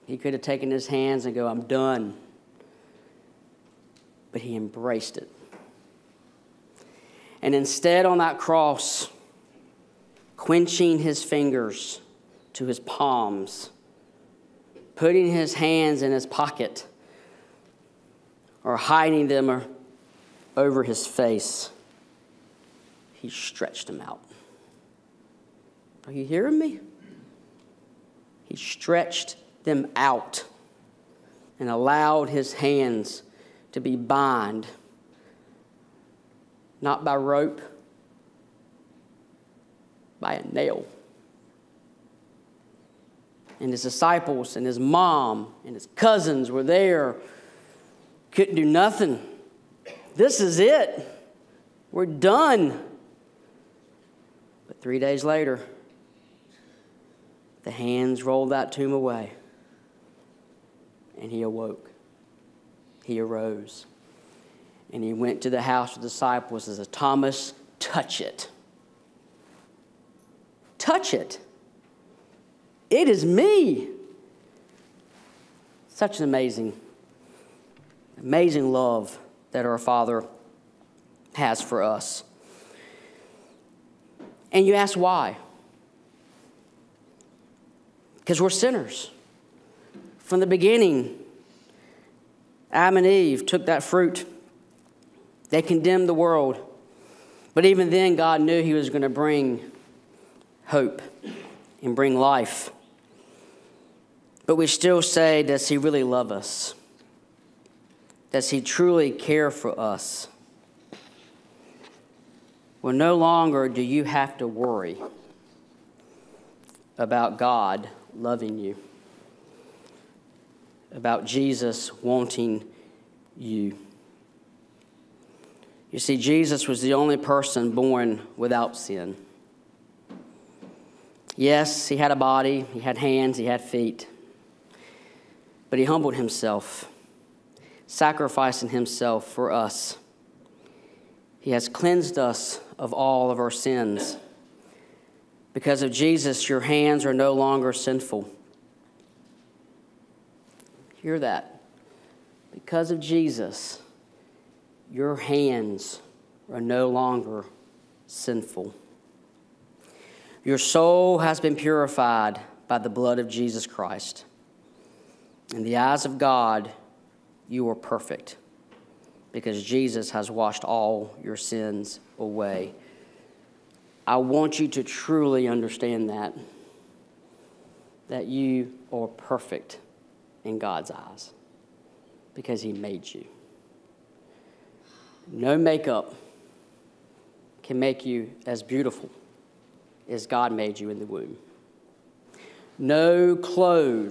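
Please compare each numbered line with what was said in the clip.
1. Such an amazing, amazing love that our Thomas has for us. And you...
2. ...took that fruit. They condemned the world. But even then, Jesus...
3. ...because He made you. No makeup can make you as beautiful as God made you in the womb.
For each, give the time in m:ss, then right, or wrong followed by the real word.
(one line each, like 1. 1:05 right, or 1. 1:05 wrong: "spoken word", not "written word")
1. 1:15 wrong: "Father", not "Thomas"
2. 1:33 wrong: "God", not "Jesus"
3. 3:02 right.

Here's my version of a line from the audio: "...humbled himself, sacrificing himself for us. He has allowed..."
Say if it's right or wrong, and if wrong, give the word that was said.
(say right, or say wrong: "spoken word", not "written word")
wrong: "cleansed", not "allowed".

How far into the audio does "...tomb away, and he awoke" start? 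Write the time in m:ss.
0:58.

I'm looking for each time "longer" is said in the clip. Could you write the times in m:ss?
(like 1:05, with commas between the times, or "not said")
1:53, 2:27, 2:36.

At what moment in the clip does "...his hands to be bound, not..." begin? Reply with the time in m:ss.
0:32.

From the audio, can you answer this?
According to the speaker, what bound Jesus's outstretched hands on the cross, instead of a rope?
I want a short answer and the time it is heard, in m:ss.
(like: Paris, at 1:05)
a nail, at 0:40.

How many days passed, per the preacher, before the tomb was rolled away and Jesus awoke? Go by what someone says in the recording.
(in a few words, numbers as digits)
3.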